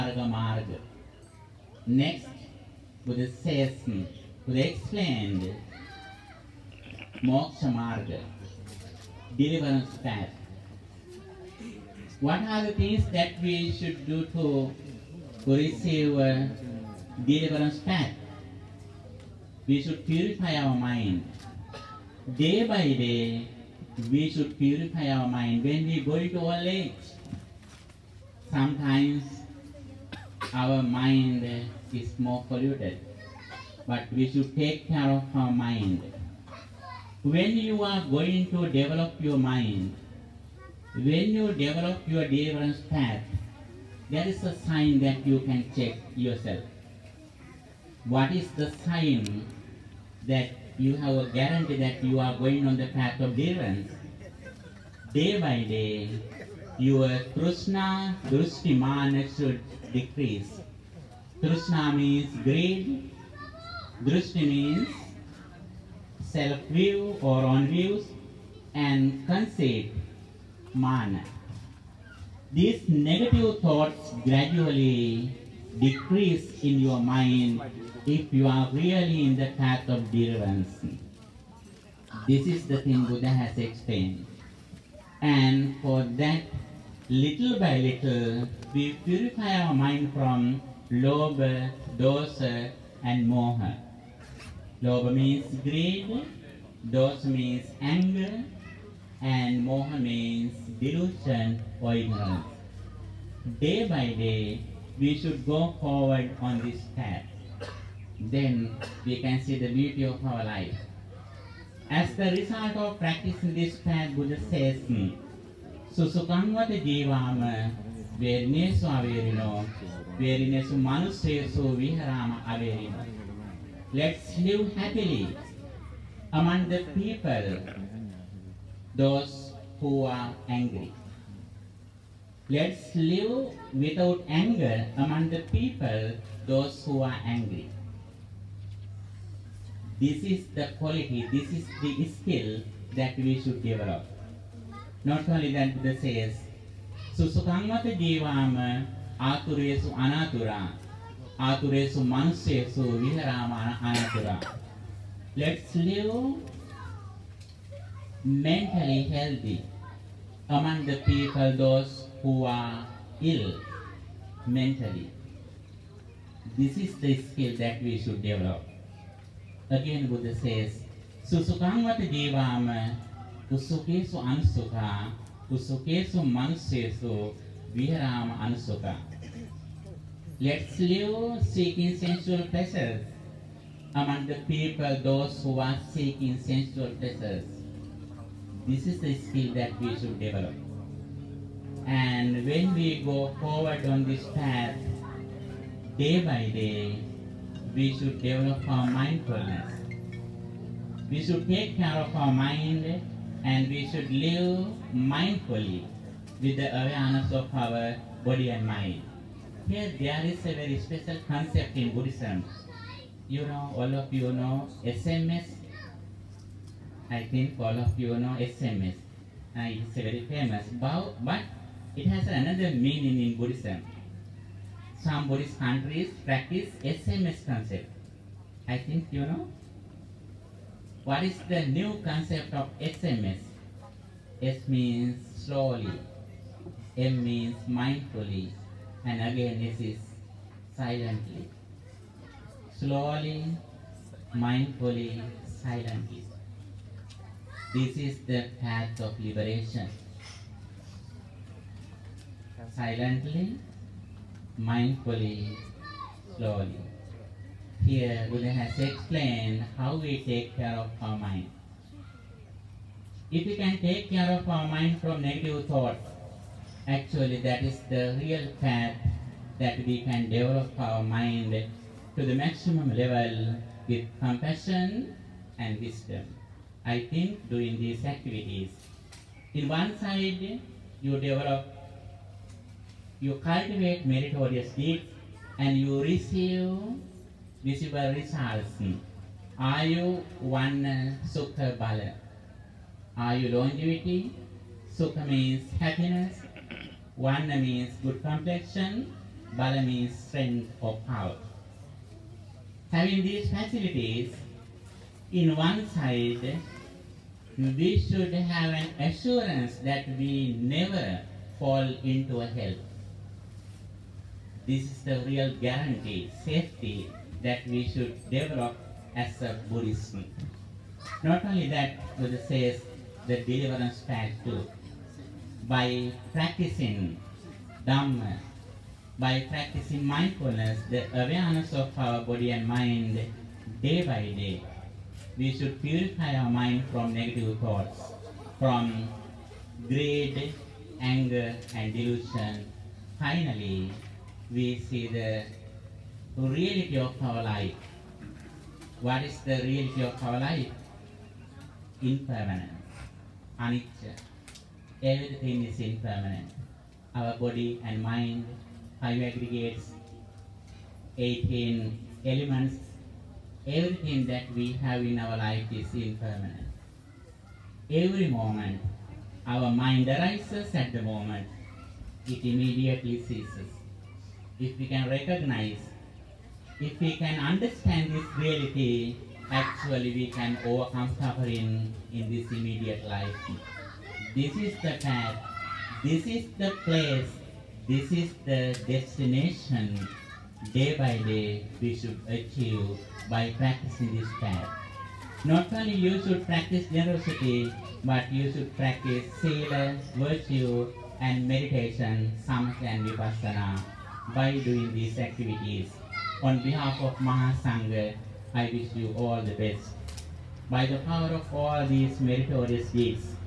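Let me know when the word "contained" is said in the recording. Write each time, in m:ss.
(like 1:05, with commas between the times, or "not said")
not said.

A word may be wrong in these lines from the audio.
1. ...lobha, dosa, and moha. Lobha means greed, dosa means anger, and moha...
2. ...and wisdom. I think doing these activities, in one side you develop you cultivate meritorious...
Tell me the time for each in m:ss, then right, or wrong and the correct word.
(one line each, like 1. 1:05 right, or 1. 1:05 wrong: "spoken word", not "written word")
1. 1:30 right
2. 4:35 right.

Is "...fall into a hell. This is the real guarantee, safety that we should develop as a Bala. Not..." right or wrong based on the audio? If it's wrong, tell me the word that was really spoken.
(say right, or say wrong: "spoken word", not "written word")
wrong: "Buddhism", not "Bala".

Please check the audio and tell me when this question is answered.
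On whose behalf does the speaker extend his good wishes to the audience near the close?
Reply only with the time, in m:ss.
6:47.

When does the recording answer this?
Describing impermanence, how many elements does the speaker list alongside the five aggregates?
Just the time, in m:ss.
6:01.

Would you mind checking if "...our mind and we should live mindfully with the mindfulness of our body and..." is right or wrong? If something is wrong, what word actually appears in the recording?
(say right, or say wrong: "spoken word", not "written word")
wrong: "awareness", not "mindfulness".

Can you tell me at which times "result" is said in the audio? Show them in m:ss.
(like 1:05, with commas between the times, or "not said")
1:52, 4:48.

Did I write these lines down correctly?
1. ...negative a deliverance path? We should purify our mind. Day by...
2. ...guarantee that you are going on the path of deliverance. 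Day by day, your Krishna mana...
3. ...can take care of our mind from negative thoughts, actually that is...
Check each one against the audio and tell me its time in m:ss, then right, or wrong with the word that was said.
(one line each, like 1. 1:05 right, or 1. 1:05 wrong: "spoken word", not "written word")
1. 0:15 wrong: "receive", not "negative"
2. 0:51 right
3. 4:23 right.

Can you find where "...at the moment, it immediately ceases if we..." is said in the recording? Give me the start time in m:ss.
6:10.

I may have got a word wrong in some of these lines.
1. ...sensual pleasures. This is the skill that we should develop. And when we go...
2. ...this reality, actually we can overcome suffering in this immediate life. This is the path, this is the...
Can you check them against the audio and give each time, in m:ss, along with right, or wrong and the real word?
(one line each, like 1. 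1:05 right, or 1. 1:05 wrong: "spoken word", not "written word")
1. 3:06 right
2. 6:18 right.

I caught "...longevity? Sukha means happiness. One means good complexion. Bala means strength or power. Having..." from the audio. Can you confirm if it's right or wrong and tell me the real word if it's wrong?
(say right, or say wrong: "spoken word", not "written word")
right.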